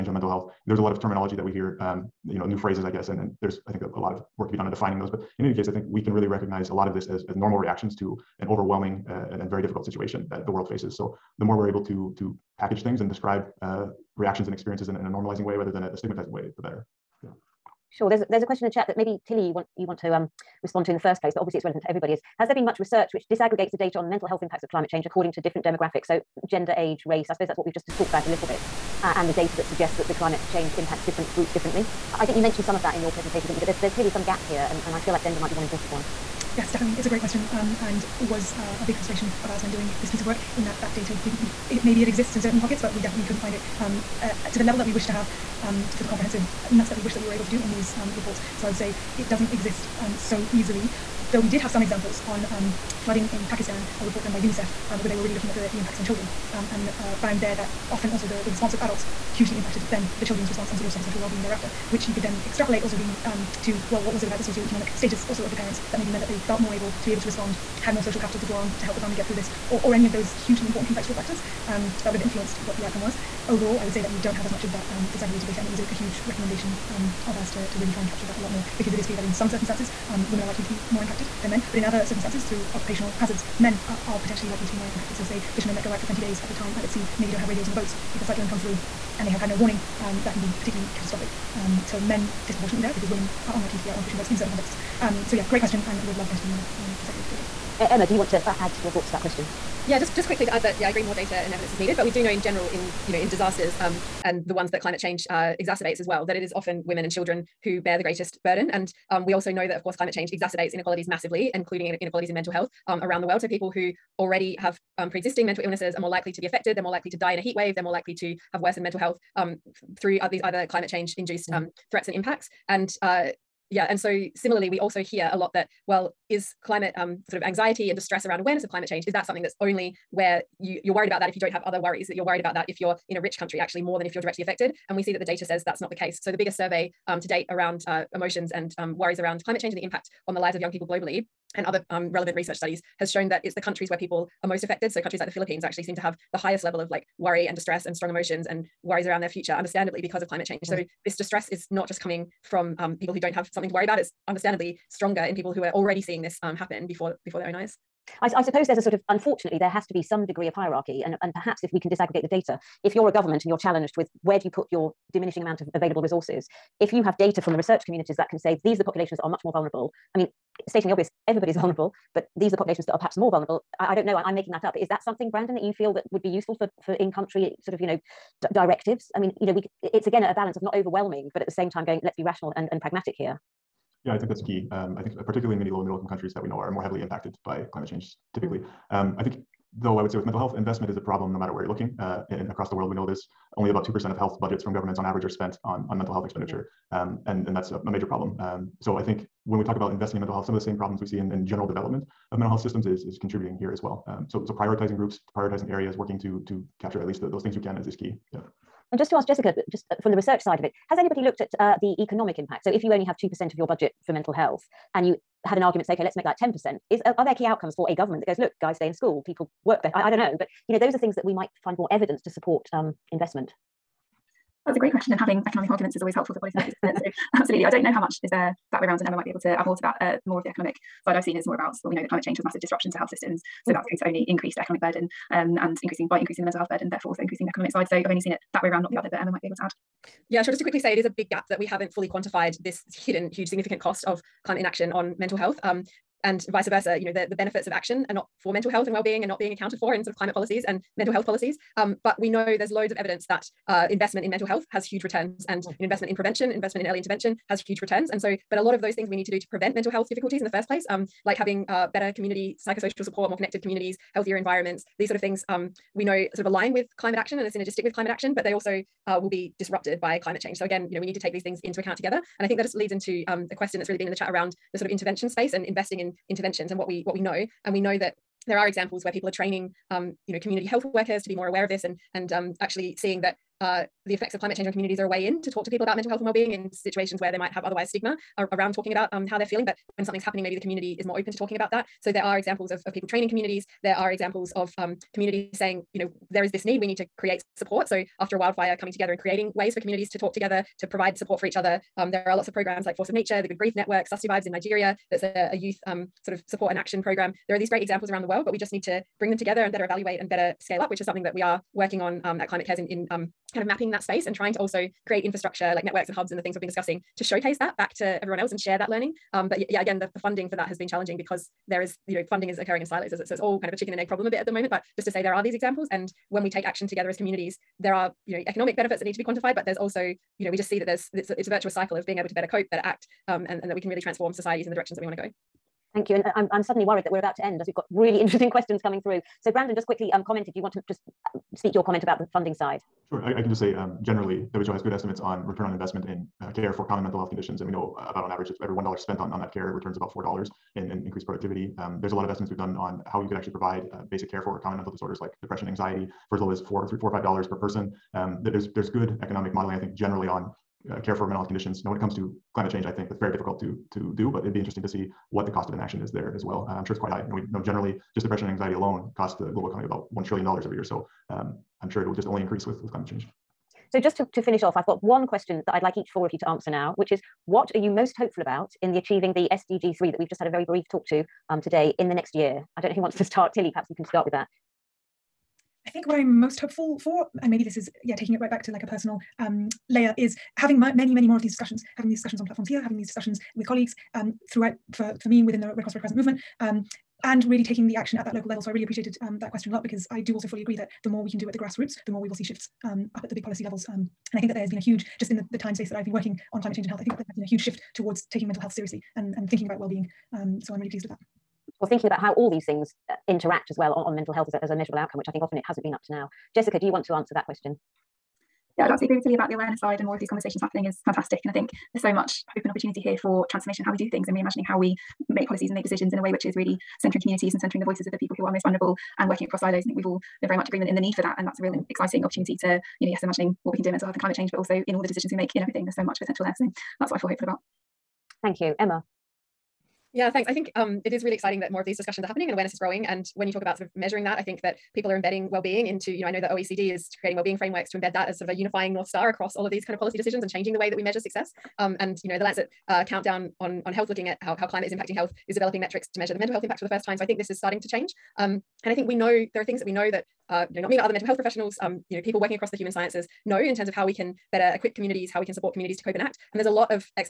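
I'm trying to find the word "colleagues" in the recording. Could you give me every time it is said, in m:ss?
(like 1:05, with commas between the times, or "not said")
6:33.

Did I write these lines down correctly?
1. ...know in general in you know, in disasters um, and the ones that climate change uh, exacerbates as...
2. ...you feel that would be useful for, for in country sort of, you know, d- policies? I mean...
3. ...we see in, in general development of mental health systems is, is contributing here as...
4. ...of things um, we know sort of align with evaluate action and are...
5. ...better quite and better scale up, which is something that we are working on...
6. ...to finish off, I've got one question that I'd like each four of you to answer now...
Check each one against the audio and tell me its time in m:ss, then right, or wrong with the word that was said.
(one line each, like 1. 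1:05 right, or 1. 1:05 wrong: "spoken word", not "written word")
1. 1:42 right
2. 2:55 wrong: "directives", not "policies"
3. 3:21 right
4. 4:25 wrong: "climate", not "evaluate"
5. 5:09 wrong: "evaluate", not "quite"
6. 6:14 right.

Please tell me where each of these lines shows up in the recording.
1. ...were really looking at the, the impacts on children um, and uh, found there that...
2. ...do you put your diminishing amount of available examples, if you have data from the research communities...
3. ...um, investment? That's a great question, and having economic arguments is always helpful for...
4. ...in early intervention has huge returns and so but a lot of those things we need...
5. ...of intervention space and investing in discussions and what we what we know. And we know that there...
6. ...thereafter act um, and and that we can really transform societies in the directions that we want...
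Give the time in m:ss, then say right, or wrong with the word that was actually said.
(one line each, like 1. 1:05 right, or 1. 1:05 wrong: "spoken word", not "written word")
1. 0:55 right
2. 2:44 wrong: "resources", not "examples"
3. 3:42 right
4. 4:16 right
5. 4:34 wrong: "interventions", not "discussions"
6. 5:32 wrong: "better", not "thereafter".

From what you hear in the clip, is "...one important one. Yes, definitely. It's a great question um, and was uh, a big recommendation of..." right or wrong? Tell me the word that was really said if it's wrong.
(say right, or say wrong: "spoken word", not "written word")
wrong: "frustration", not "recommendation".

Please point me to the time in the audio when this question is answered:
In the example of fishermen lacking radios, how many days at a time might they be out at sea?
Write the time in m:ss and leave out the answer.
1:26.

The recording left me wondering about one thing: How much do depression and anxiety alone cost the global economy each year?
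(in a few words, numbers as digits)
1 trillion dollars.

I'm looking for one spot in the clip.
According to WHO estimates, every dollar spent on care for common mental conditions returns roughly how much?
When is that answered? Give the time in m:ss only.
5:50.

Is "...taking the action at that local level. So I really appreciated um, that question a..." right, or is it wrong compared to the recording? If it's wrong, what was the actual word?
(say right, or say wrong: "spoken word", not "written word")
right.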